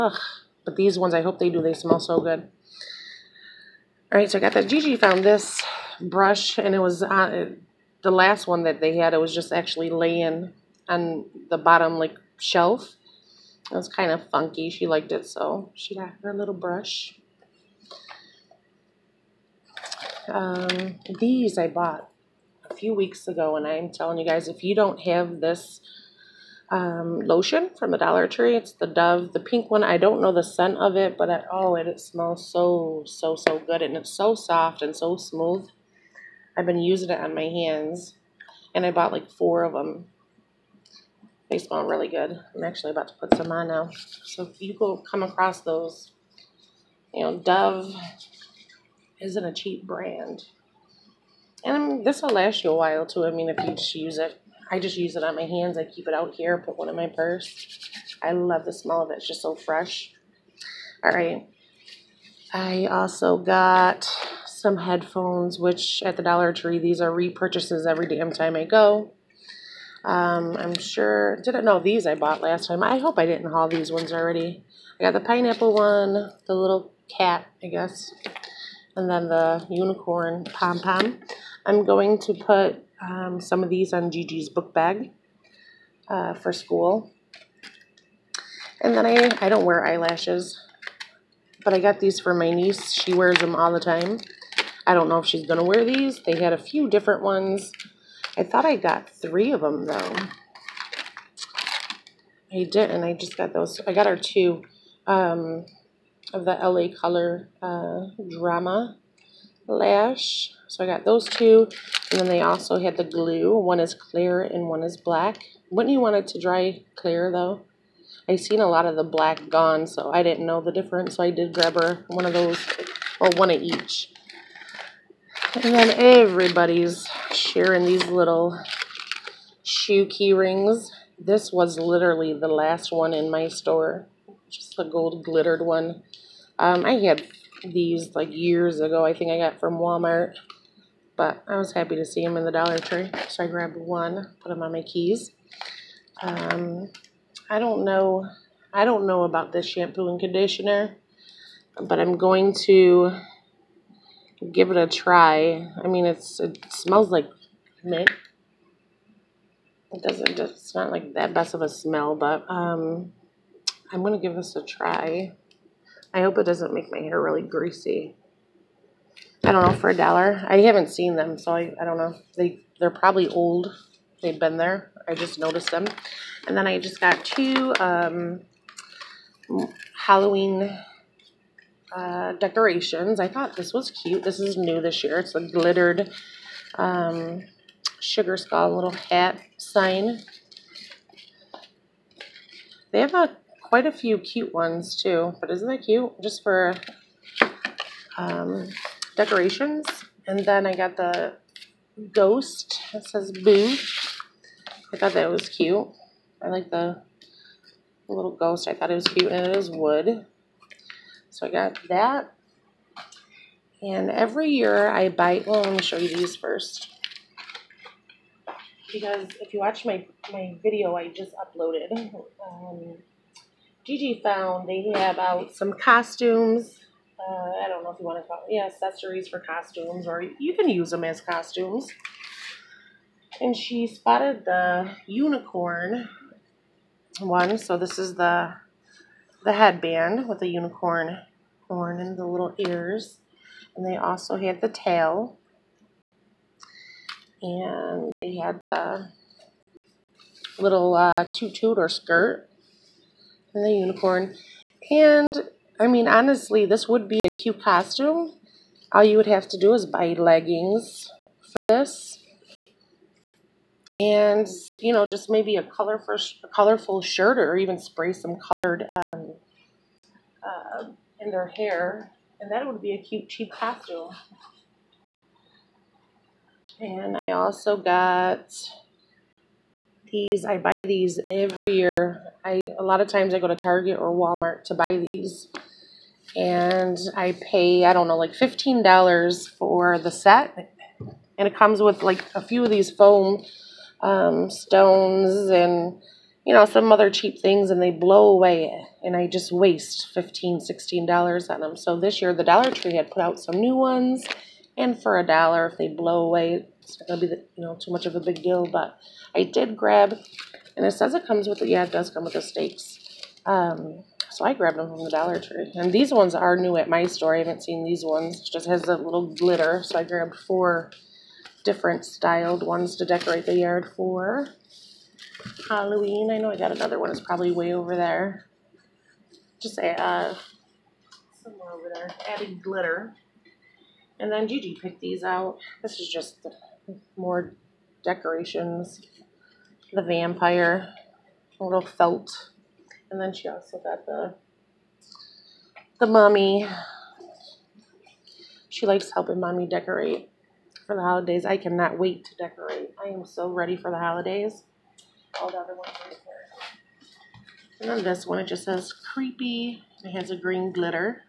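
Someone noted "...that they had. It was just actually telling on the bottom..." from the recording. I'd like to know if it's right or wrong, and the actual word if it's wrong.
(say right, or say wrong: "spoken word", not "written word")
wrong: "laying", not "telling".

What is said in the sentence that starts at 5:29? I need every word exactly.
Just say uh, somewhere over there.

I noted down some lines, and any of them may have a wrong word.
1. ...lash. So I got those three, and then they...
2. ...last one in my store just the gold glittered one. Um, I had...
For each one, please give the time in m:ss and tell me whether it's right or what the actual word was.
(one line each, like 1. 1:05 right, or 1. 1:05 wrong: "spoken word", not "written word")
1. 1:49 wrong: "two", not "three"
2. 2:12 right.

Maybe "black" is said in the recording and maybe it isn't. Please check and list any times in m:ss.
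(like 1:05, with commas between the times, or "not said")
1:54, 1:59.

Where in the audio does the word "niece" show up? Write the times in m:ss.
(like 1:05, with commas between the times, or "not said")
1:32.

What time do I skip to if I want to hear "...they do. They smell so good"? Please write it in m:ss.
0:01.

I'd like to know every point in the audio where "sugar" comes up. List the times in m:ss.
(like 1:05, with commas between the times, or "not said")
3:07.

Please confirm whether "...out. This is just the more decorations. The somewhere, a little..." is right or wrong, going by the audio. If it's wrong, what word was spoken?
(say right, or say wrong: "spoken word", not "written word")
wrong: "vampire", not "somewhere".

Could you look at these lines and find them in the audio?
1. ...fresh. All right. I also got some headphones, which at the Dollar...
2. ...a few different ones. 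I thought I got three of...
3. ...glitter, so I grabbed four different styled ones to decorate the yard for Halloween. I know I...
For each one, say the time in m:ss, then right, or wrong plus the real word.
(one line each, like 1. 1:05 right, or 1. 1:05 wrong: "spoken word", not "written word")
1. 0:59 right
2. 1:36 right
3. 5:19 right.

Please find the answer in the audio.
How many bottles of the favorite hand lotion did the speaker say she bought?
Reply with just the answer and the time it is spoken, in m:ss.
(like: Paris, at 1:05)
4, at 0:38.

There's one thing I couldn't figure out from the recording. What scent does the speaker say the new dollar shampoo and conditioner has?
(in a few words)
Mint.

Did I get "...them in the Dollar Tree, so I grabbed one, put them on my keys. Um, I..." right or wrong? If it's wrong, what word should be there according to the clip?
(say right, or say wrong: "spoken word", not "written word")
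right.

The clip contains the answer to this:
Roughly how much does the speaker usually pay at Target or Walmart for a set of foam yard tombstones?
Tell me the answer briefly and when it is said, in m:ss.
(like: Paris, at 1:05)
$15, at 4:48.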